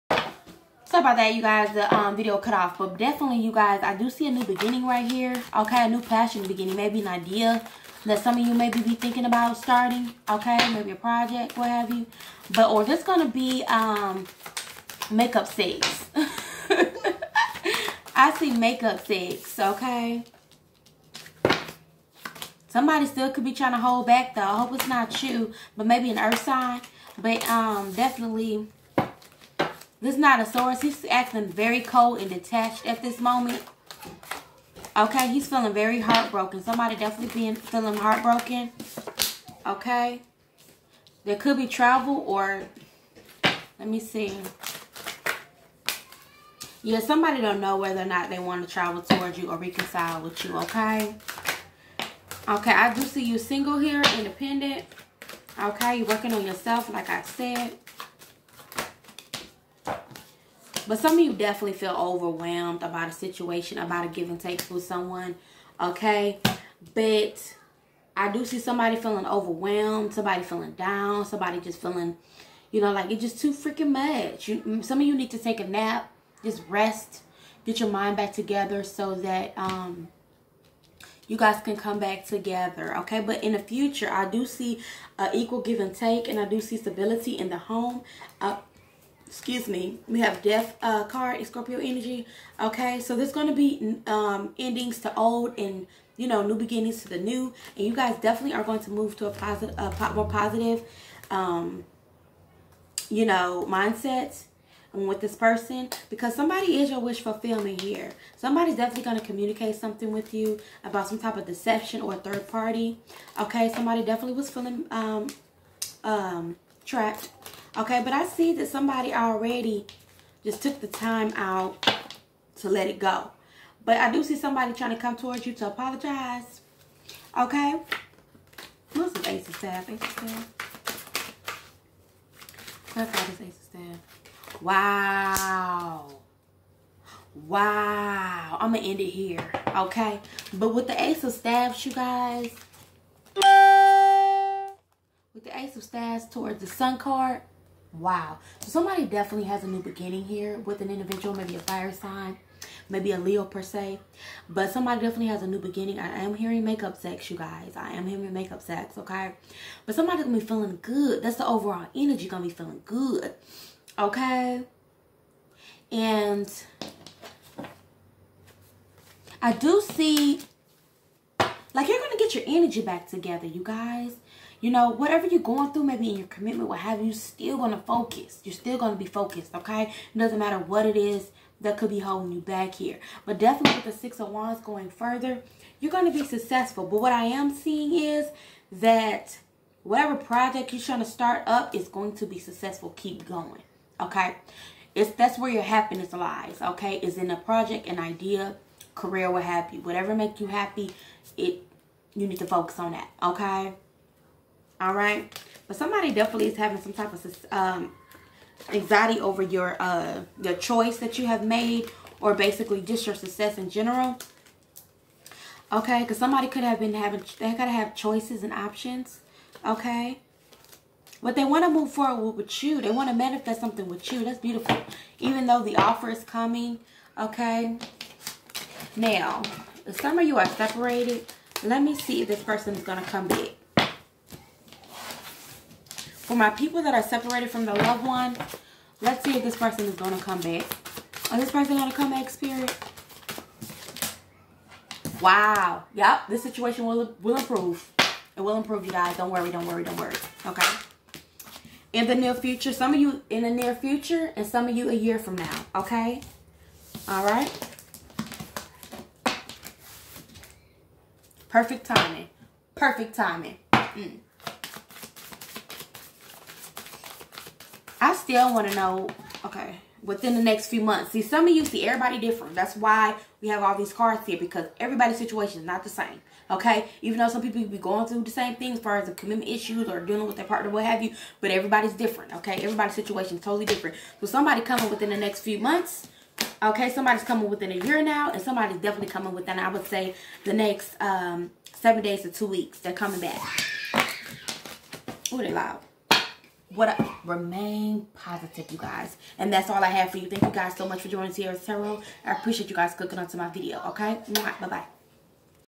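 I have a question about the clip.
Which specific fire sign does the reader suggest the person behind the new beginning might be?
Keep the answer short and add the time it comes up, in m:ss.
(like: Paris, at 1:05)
Leo, at 2:33.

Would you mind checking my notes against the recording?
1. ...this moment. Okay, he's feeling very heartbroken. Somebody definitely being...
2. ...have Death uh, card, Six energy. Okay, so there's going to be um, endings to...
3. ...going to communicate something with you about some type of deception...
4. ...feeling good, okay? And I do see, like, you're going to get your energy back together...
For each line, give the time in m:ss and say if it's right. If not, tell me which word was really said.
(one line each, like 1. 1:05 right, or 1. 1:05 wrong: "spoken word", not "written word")
1. 0:33 right
2. 1:30 wrong: "Scorpio", not "Six"
3. 1:49 right
4. 2:42 right.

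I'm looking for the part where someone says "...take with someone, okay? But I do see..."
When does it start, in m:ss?
1:04.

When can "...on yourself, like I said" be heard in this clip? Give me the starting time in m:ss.
0:56.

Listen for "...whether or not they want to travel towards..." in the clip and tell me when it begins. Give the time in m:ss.
0:47.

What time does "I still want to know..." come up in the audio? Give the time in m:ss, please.
4:28.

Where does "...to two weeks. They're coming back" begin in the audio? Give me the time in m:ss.
4:52.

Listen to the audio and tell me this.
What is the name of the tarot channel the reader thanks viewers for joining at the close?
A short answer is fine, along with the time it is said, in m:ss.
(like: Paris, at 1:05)
Tiara's Tarot, at 5:01.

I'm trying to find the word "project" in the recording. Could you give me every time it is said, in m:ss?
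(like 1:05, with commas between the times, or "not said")
0:10, 3:10, 3:17.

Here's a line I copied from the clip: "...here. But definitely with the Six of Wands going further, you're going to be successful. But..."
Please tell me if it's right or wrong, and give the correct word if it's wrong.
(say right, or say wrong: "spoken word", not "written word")
right.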